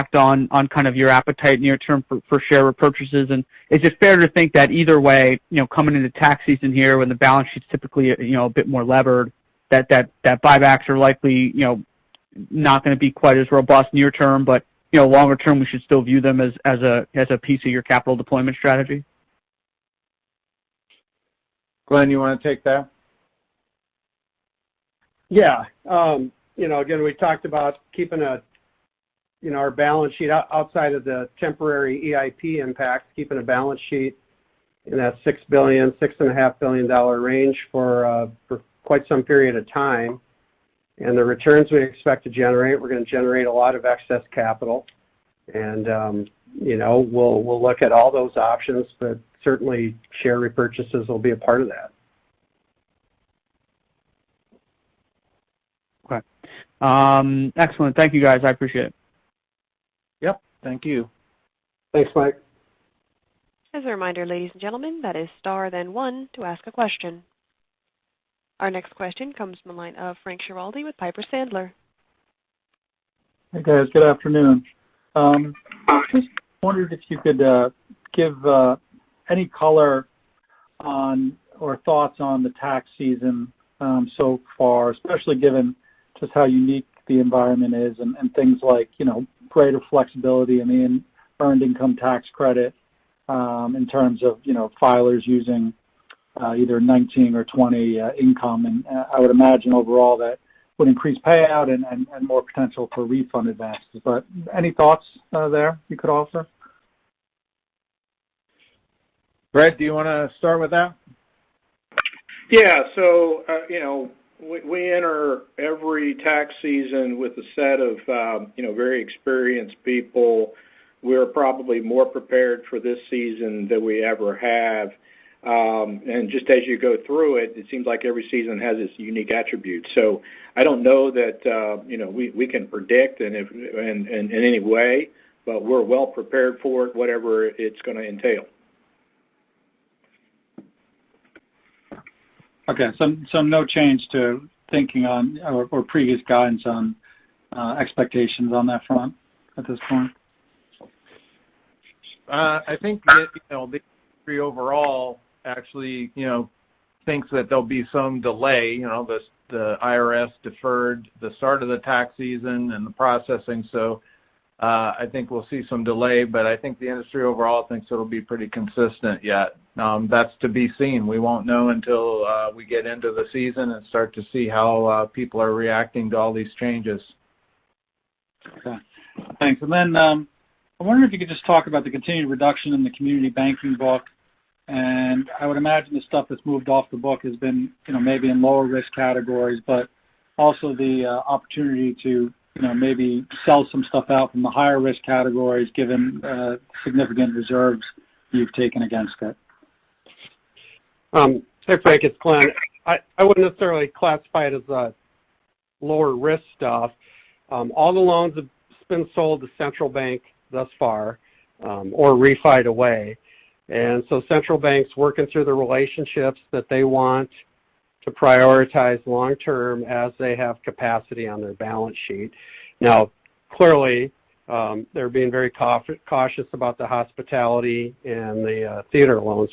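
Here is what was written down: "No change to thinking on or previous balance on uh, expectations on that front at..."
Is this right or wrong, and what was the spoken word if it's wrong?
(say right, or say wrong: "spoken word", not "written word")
wrong: "guidance", not "balance".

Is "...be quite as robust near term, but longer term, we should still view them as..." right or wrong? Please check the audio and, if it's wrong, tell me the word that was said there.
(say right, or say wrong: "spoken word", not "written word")
right.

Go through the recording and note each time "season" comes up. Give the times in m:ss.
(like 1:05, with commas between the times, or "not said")
0:06, 1:22, 1:56, 2:03, 2:08, 2:42, 2:53.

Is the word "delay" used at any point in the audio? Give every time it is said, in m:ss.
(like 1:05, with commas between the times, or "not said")
2:38, 2:45.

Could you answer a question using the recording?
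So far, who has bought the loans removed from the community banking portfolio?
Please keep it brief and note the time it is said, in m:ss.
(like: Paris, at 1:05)
central bank, at 3:29.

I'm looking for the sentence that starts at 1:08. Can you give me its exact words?
Our next question comes from the line of Frank Schiraldi with Piper Sandler.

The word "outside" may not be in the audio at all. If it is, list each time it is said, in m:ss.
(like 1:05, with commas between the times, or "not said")
0:30.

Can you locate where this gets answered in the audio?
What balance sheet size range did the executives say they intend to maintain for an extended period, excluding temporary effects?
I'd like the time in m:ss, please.
0:35.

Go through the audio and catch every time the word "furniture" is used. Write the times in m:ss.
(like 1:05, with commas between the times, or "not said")
not said.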